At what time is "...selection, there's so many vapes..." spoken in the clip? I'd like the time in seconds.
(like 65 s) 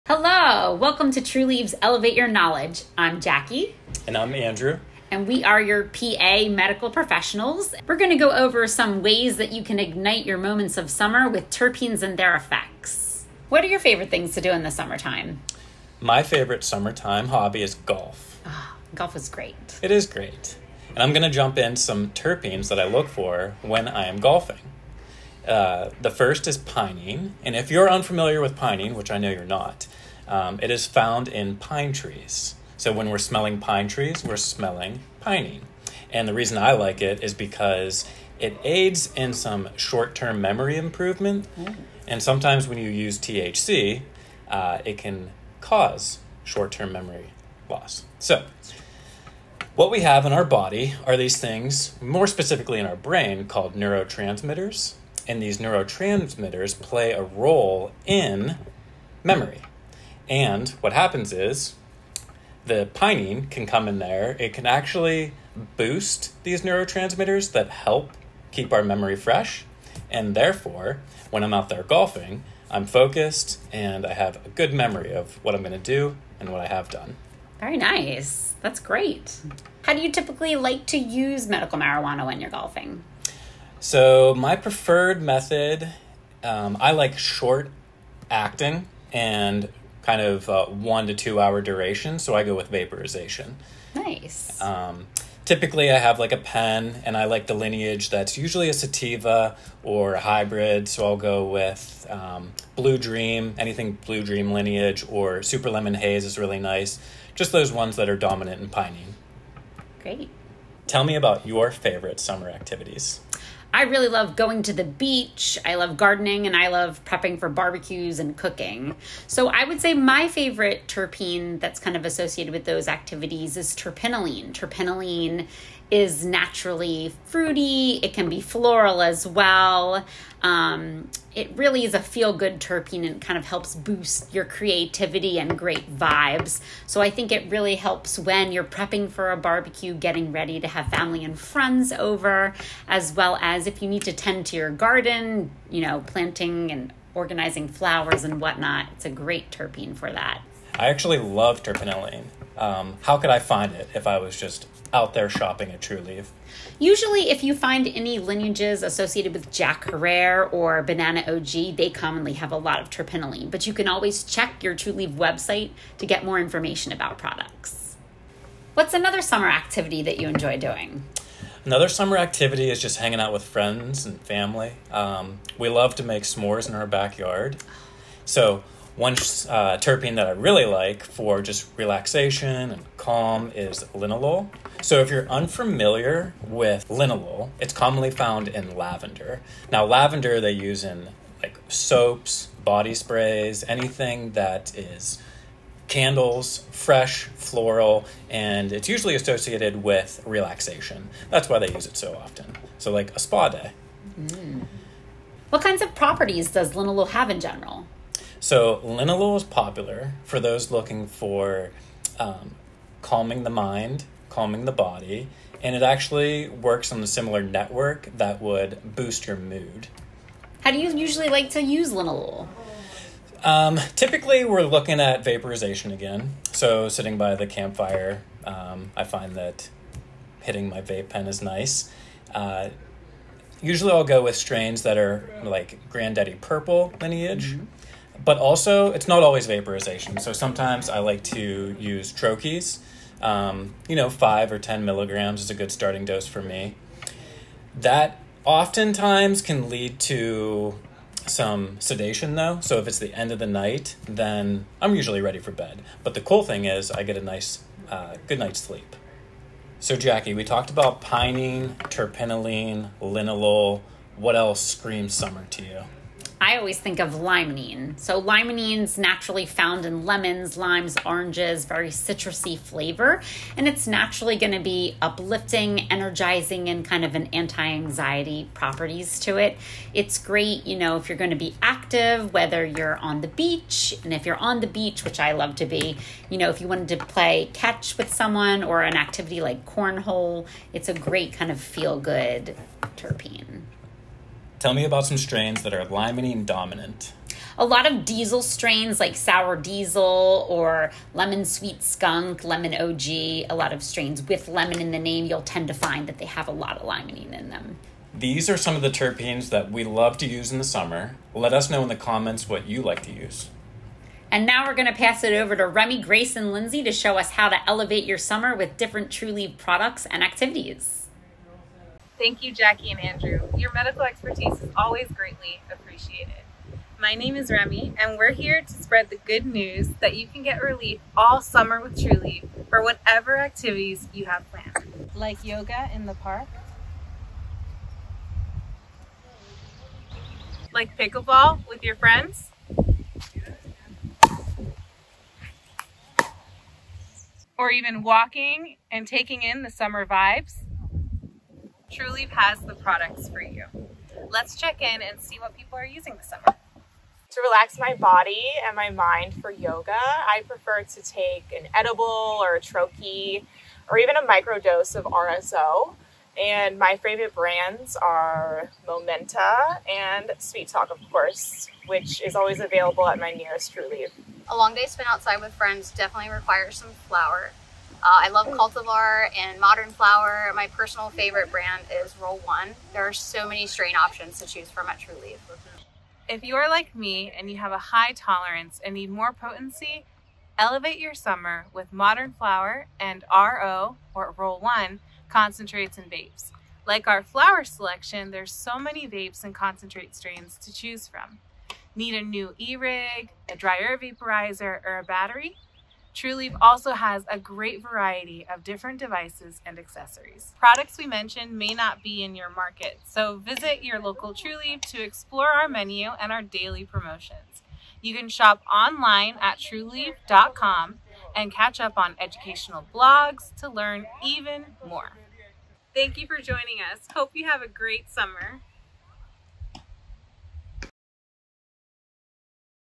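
397 s.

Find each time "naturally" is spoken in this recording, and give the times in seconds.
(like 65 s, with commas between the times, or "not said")
126 s, 268 s, 273 s.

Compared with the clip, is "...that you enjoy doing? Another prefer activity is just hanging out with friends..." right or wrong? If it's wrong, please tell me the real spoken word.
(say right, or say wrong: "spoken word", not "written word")
wrong: "summer", not "prefer".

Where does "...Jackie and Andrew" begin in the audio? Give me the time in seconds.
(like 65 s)
322 s.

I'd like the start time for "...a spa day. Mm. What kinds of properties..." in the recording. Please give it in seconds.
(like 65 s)
203 s.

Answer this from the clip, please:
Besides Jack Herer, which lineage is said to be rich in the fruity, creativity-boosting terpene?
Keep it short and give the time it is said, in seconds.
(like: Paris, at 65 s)
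Banana OG, at 160 s.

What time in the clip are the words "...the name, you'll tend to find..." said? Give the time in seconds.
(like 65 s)
304 s.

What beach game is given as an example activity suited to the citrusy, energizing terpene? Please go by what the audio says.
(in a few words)
Cornhole.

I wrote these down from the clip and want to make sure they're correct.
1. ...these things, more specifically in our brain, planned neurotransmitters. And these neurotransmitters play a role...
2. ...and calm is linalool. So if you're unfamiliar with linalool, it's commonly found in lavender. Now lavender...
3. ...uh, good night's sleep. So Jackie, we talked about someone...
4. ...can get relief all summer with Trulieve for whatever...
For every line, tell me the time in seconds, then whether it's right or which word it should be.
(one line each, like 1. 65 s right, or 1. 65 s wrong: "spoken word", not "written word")
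1. 51 s wrong: "called", not "planned"
2. 182 s right
3. 257 s wrong: "pinene", not "someone"
4. 330 s right.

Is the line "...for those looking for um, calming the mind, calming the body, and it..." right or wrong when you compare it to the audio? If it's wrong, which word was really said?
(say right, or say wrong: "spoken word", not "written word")
right.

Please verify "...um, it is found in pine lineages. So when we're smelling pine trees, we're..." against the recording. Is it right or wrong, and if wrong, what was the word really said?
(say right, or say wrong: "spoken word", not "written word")
wrong: "trees", not "lineages".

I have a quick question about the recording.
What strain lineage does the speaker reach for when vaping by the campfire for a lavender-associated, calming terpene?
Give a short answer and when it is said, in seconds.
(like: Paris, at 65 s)
Granddaddy Purple, at 235 s.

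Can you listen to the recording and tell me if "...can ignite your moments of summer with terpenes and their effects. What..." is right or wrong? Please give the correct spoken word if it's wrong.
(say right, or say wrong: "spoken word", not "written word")
right.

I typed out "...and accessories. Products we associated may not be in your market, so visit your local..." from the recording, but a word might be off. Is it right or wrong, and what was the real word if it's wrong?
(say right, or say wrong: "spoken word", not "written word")
wrong: "mentioned", not "associated".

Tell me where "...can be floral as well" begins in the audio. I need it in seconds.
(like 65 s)
128 s.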